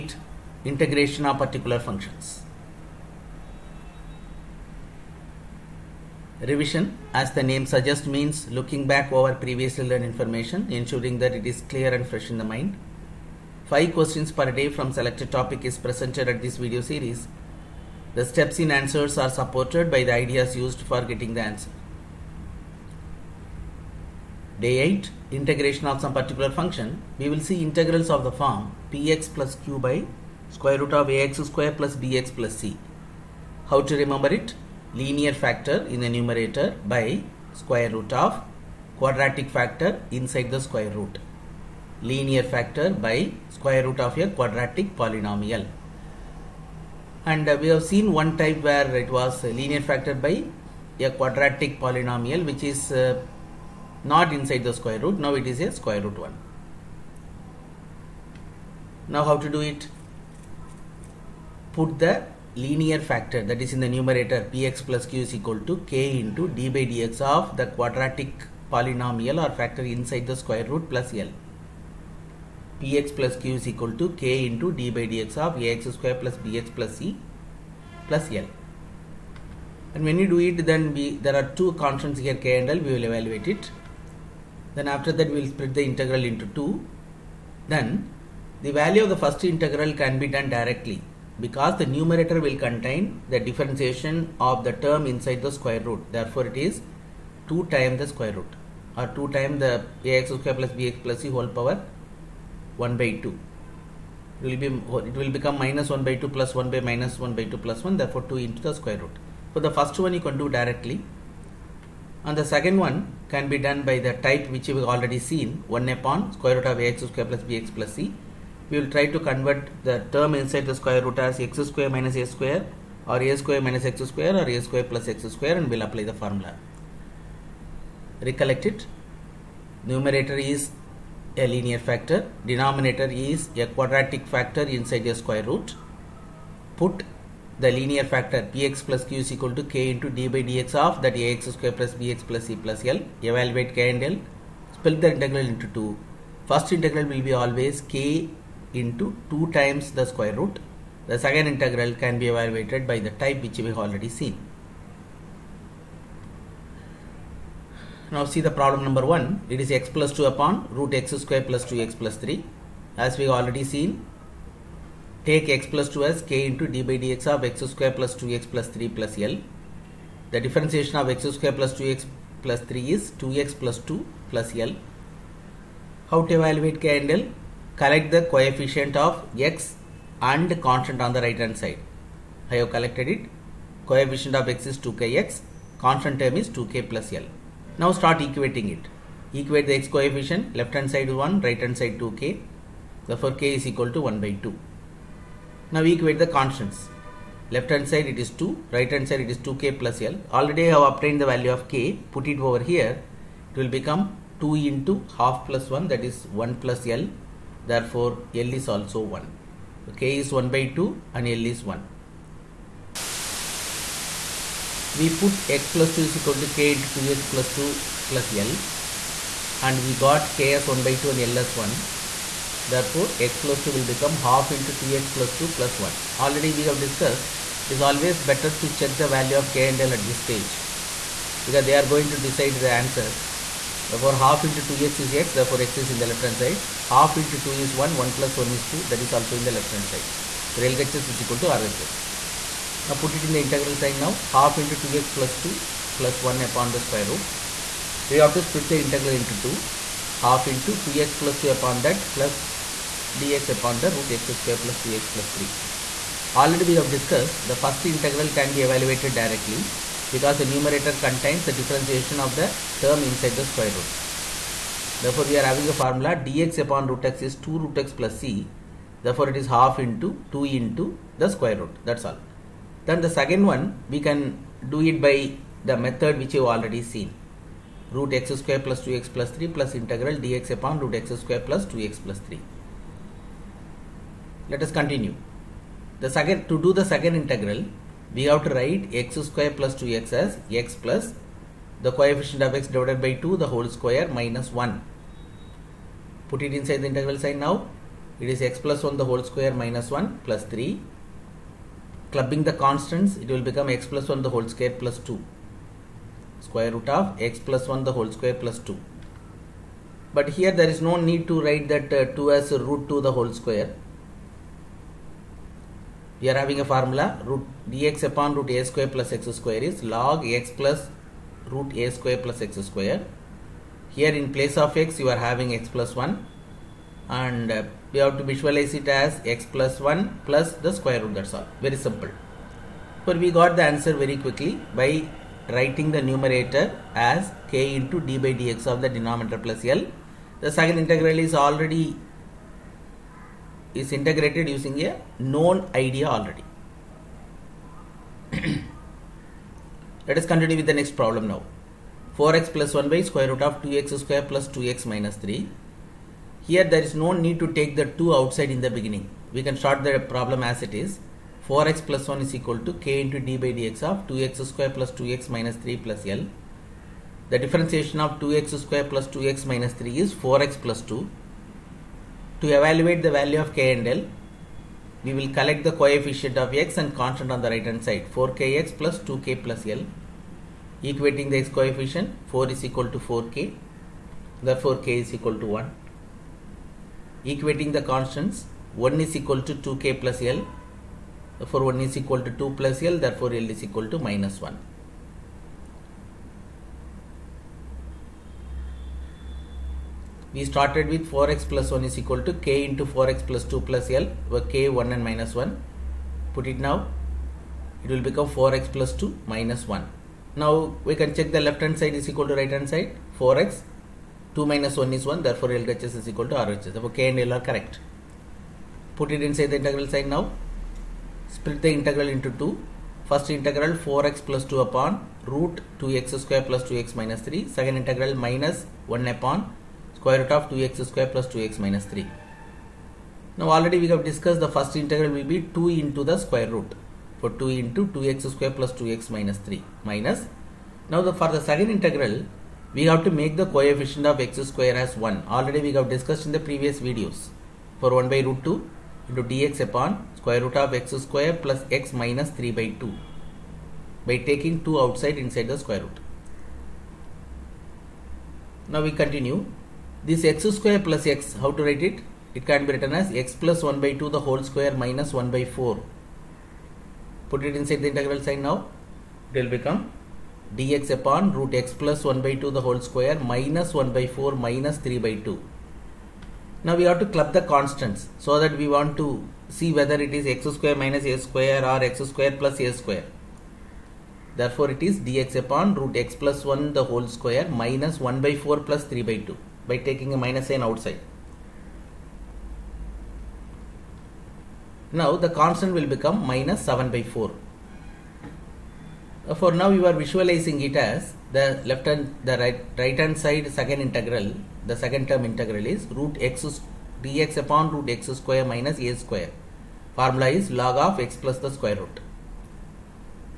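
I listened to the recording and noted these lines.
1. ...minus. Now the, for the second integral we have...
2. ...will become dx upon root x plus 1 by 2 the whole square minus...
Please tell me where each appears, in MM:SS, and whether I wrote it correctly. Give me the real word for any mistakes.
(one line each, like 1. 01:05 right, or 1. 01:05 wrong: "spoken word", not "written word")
1. 07:19 right
2. 07:49 right.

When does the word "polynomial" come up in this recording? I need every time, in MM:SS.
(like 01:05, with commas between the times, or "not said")
00:44, 00:51, 01:08.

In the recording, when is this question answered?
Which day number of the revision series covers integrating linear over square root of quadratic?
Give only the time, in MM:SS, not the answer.
00:24.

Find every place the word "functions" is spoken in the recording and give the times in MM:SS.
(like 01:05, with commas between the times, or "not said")
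00:01, 00:26.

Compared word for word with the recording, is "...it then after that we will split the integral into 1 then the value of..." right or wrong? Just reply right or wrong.
wrong.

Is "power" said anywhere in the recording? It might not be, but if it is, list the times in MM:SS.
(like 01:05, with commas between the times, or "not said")
01:41.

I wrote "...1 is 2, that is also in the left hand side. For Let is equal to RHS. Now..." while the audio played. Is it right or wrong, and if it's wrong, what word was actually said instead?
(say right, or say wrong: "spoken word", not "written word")
wrong: "LHS", not "Let".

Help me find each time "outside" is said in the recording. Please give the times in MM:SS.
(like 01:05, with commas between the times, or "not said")
05:58, 07:34, 08:10.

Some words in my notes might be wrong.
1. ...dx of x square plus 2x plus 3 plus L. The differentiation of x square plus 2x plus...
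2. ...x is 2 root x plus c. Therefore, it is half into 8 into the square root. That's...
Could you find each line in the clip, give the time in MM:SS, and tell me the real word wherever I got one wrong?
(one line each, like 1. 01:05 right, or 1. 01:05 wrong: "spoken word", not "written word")
1. 02:47 right
2. 04:27 wrong: "2", not "8".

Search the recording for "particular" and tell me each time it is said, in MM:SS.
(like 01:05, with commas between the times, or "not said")
00:01, 00:26.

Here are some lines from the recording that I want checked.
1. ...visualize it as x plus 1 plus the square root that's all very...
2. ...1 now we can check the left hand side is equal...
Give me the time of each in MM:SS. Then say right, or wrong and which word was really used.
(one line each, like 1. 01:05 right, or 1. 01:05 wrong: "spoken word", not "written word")
1. 05:28 right
2. 06:49 right.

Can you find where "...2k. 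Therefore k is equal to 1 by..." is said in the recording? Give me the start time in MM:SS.
03:11.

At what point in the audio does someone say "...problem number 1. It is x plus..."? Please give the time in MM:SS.
02:38.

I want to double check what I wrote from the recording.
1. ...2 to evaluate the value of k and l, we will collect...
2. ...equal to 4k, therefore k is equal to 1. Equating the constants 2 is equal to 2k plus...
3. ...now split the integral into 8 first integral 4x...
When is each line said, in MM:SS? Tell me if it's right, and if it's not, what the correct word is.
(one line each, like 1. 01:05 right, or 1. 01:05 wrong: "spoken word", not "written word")
1. 06:10 right
2. 06:22 wrong: "1", not "2"
3. 07:00 wrong: "2", not "8".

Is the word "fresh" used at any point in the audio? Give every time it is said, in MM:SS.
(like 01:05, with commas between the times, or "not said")
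00:12.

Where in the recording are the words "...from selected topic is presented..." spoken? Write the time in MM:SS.
00:14.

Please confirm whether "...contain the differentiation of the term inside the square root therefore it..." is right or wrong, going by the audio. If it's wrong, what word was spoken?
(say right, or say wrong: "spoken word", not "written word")
right.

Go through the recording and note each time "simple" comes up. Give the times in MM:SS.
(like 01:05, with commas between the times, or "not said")
05:31.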